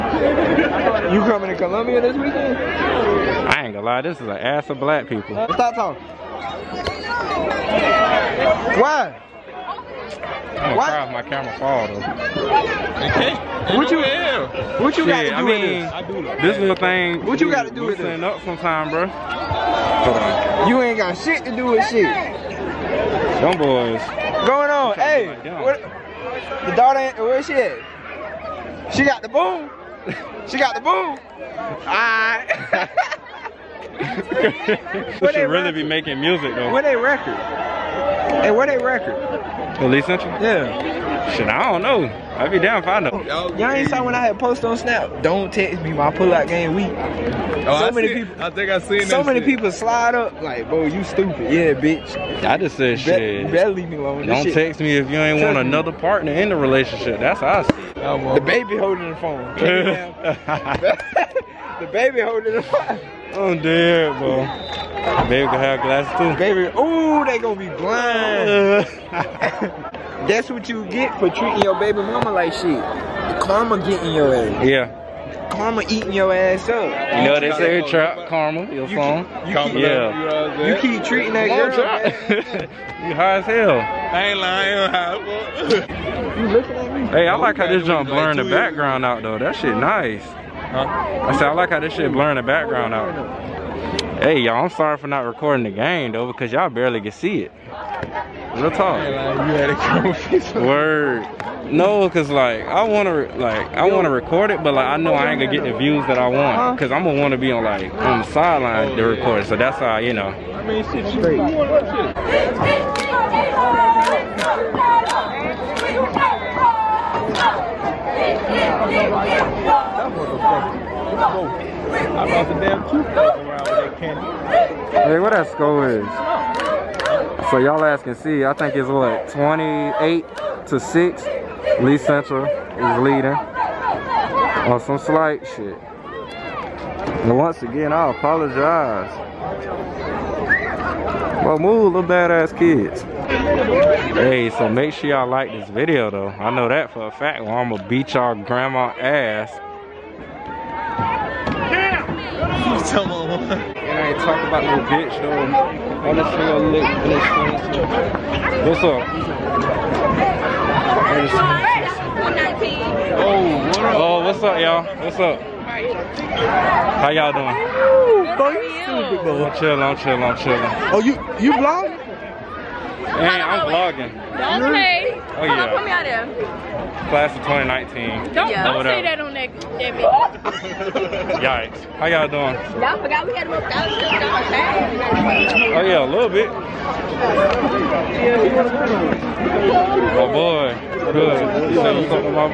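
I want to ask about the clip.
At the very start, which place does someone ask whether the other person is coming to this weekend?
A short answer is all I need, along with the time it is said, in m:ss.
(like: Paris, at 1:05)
Columbia, at 0:01.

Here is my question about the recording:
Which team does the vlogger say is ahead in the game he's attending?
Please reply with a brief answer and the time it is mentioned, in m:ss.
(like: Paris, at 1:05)
Lee Central, at 2:11.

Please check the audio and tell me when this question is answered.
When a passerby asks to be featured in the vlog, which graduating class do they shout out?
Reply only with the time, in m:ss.
2:57.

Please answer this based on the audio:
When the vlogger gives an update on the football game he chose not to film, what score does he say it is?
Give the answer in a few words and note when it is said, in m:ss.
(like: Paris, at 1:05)
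28 to 6, at 2:09.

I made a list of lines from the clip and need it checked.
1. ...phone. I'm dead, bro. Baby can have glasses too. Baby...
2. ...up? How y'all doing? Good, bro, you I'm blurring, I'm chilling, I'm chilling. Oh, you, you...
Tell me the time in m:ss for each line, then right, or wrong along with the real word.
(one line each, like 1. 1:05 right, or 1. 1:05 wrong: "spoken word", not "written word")
1. 1:02 right
2. 2:45 wrong: "chilling", not "blurring".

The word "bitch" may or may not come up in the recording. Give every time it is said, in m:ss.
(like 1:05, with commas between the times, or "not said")
0:51, 2:34.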